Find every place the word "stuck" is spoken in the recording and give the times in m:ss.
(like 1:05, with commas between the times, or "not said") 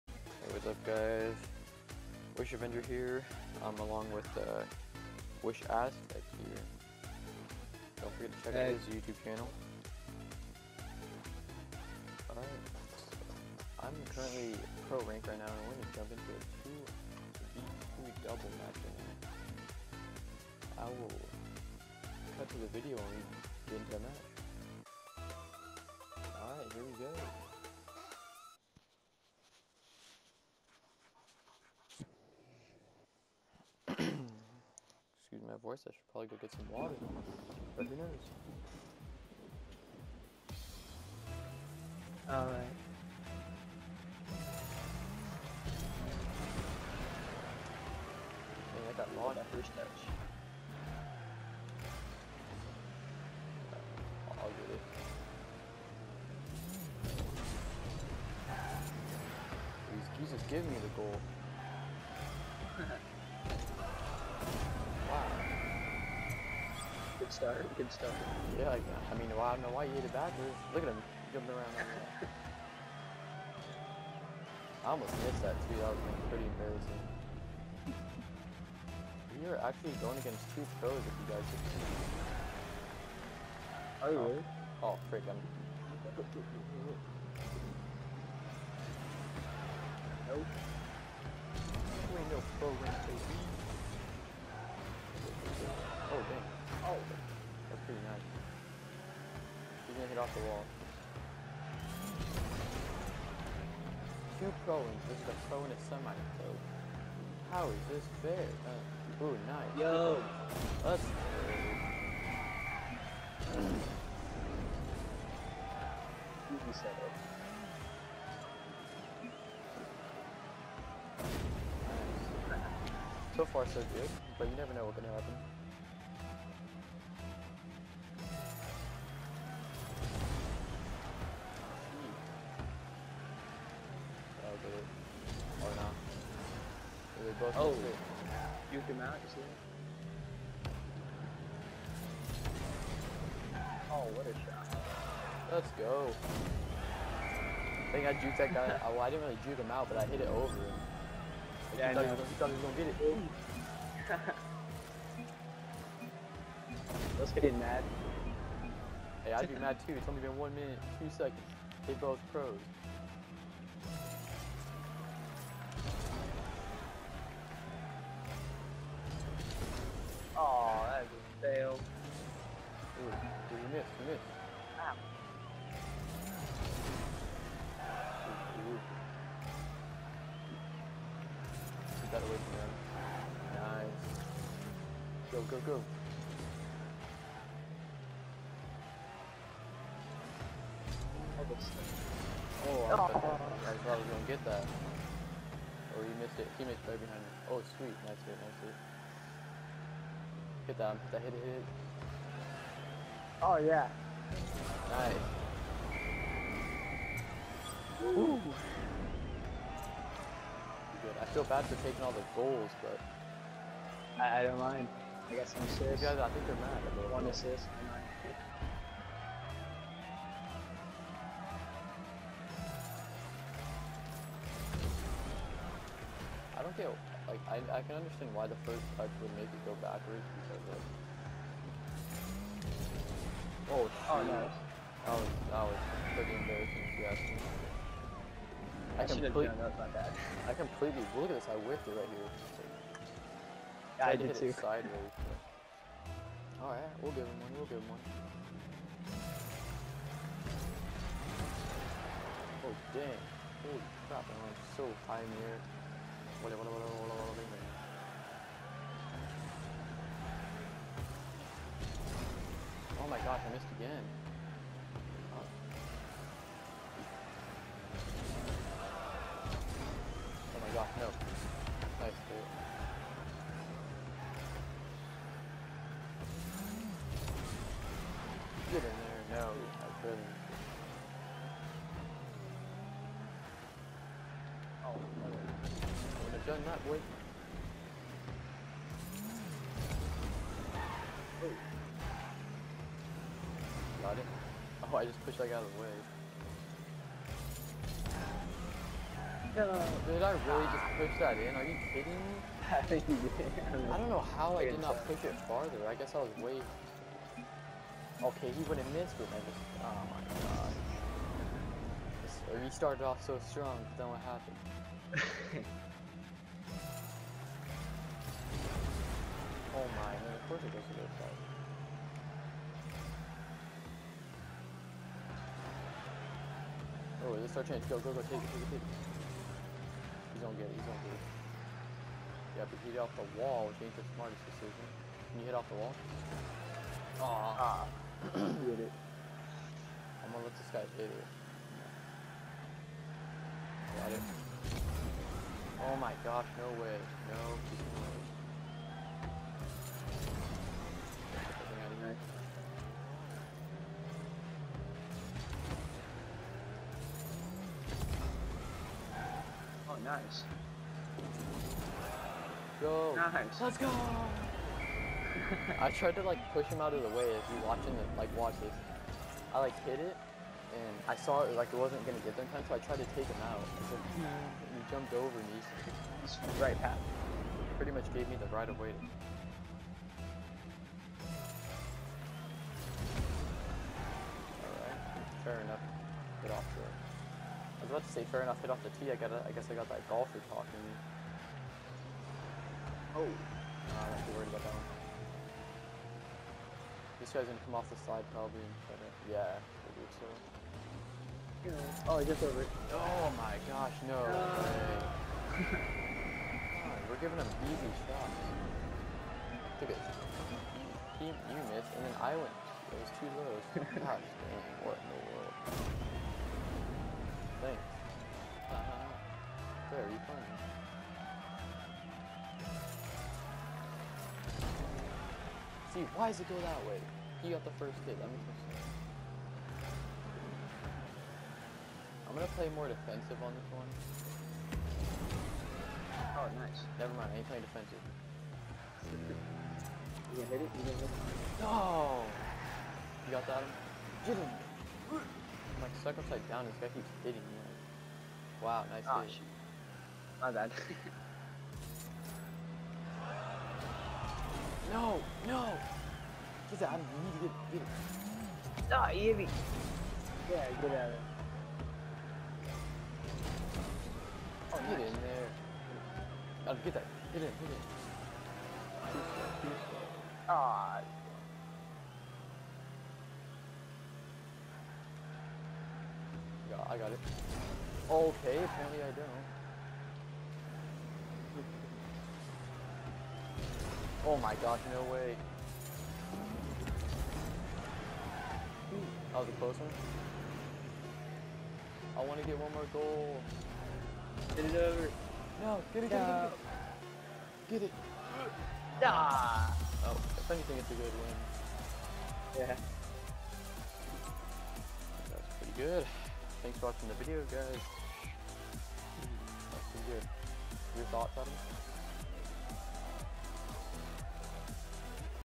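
7:26.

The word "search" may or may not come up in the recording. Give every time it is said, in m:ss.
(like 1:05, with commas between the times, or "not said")
not said.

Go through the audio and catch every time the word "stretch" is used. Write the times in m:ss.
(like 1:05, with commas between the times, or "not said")
not said.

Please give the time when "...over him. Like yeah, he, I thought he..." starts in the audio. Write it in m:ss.
2:30.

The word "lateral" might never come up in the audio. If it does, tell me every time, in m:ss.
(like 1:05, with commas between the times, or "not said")
not said.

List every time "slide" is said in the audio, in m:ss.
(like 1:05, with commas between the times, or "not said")
6:38.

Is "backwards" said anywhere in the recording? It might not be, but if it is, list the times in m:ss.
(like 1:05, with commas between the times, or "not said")
1:10, 3:49.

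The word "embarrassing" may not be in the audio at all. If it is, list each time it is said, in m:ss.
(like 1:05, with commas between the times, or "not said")
1:16, 3:56.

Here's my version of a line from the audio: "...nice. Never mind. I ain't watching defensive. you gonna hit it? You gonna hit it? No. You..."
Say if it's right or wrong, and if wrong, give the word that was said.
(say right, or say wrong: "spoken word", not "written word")
wrong: "playing", not "watching".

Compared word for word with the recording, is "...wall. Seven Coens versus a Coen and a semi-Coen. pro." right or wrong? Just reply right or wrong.
wrong.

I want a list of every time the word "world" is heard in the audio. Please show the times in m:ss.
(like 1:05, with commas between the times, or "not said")
6:55.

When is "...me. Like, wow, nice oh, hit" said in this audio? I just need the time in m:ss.
7:27.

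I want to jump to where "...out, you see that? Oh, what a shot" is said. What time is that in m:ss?
2:19.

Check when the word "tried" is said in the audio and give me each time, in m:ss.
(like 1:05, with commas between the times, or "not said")
6:05, 6:12.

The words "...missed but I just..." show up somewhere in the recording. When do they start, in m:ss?
5:08.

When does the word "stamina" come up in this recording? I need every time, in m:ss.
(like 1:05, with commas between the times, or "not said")
not said.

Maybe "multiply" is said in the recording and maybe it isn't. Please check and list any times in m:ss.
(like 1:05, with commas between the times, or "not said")
not said.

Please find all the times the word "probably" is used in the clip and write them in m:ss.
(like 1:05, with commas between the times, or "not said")
0:36, 6:38.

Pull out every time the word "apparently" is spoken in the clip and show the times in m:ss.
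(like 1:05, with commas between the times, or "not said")
7:58.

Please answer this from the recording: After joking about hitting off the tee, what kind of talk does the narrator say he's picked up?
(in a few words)
golfer talking.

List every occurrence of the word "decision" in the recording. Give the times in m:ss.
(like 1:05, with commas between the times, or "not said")
5:34.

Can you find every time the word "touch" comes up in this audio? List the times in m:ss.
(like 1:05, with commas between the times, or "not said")
0:49, 3:48.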